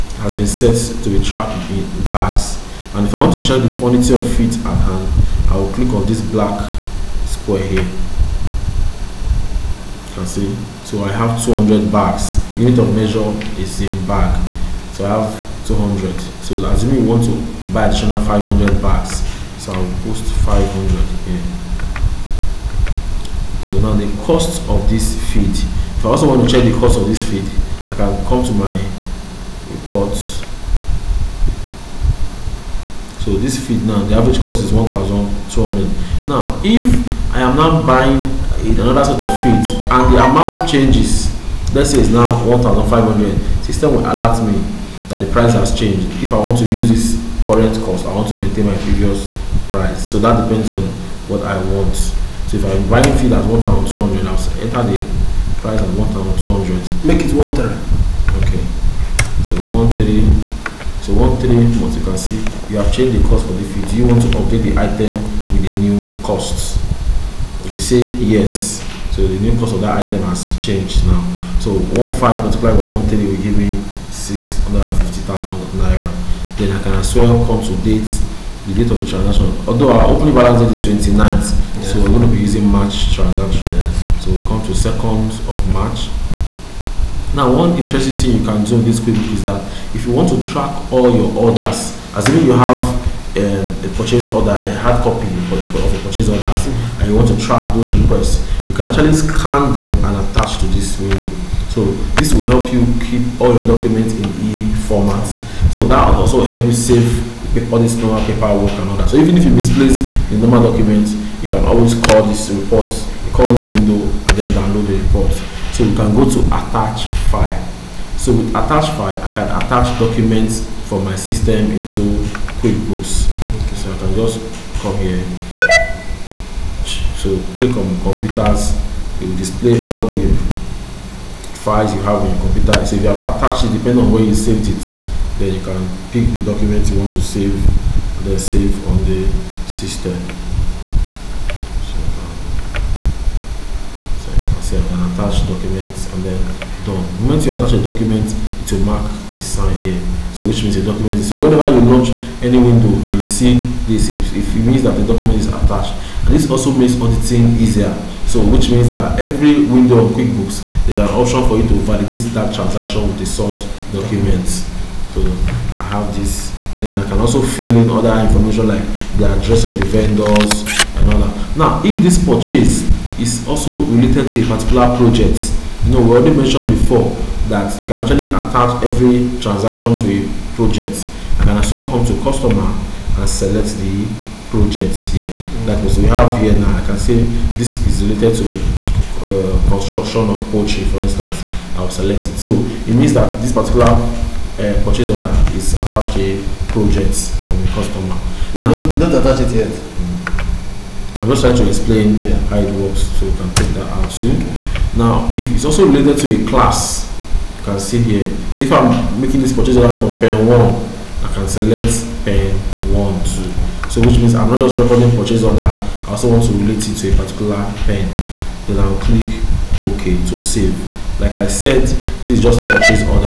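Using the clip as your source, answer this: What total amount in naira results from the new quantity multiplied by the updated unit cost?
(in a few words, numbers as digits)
650,000 naira.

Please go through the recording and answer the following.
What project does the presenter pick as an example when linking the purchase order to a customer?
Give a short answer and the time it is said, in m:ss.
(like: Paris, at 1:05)
Construction of poultry, at 3:09.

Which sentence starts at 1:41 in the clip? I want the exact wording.
So this will help you keep all your documents in e-formats.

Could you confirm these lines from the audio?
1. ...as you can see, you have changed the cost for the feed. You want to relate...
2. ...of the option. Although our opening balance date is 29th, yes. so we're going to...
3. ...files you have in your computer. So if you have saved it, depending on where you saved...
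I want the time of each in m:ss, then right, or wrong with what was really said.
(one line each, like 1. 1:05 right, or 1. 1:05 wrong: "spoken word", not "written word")
1. 1:01 wrong: "update", not "relate"
2. 1:18 wrong: "transaction", not "option"
3. 2:11 wrong: "attached", not "saved".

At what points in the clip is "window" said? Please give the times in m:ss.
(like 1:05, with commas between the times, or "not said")
1:40, 1:53, 2:32, 2:39.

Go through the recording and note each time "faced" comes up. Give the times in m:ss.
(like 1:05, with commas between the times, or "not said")
not said.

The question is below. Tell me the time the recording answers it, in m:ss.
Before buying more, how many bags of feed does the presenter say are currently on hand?
0:11.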